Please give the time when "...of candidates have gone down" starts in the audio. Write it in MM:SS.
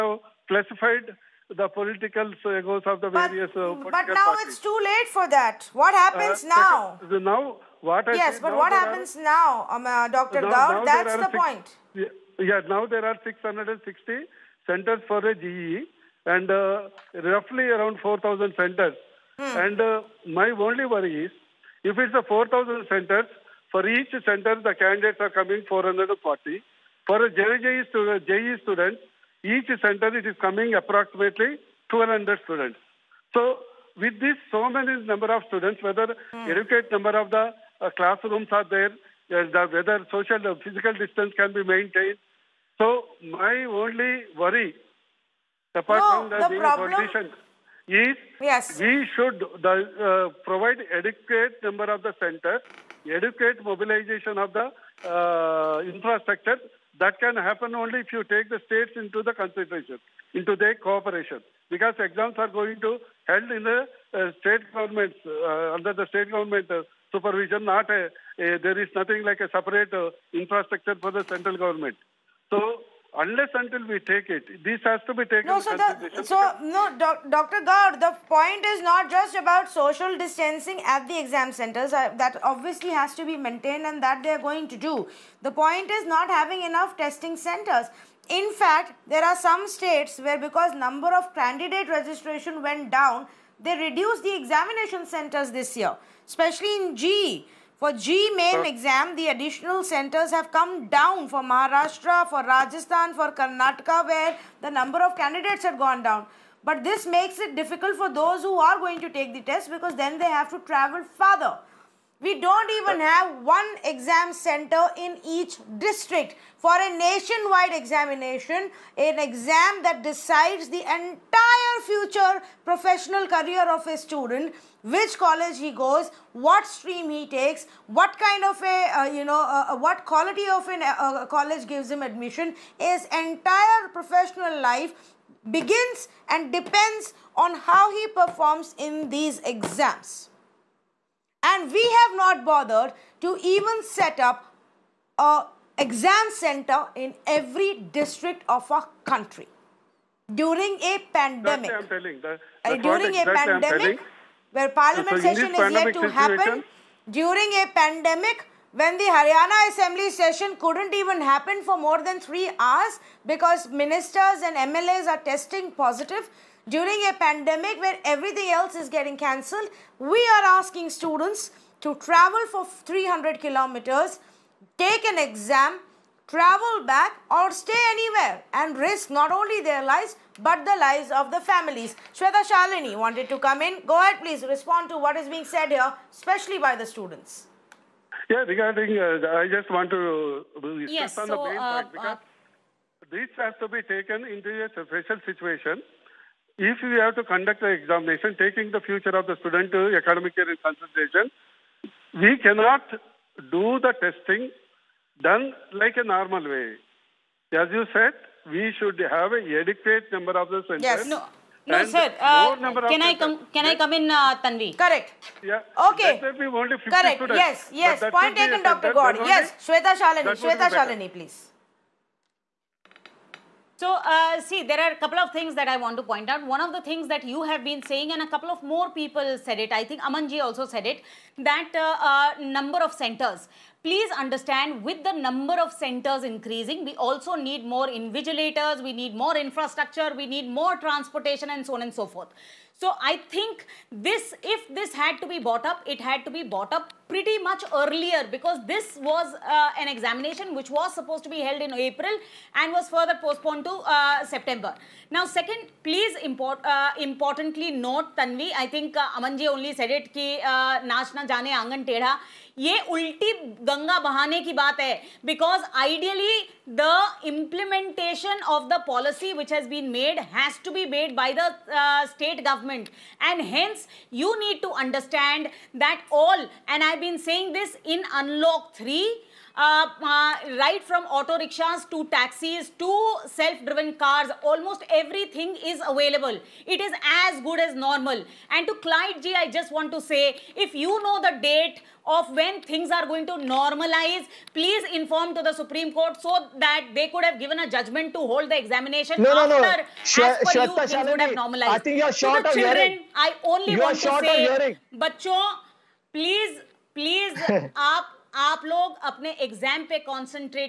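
01:45.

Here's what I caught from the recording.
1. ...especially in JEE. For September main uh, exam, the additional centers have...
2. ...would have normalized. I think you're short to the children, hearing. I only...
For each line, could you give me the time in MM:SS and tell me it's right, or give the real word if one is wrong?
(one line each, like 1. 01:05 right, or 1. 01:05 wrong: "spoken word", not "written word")
1. 01:36 wrong: "JEE", not "September"
2. 05:01 right.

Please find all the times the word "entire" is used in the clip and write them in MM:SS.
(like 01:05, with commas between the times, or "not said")
02:00, 02:13.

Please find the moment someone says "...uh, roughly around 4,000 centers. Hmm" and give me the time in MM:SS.
00:16.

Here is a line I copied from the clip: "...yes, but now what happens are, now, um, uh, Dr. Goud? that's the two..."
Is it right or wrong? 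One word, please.
wrong.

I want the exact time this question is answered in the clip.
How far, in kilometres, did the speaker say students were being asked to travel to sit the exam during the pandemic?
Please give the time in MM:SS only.
02:52.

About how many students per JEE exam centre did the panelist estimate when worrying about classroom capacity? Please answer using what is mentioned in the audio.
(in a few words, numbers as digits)
1200.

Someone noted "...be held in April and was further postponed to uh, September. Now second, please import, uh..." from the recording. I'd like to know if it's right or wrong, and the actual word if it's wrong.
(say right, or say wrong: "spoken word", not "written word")
right.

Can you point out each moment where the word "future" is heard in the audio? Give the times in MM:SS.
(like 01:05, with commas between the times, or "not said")
02:01, 03:18.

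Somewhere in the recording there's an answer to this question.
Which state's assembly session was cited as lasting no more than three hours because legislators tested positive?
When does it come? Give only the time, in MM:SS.
02:39.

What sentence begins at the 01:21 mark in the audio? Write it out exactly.
Uh, that obviously has to be maintained and that they are going to do.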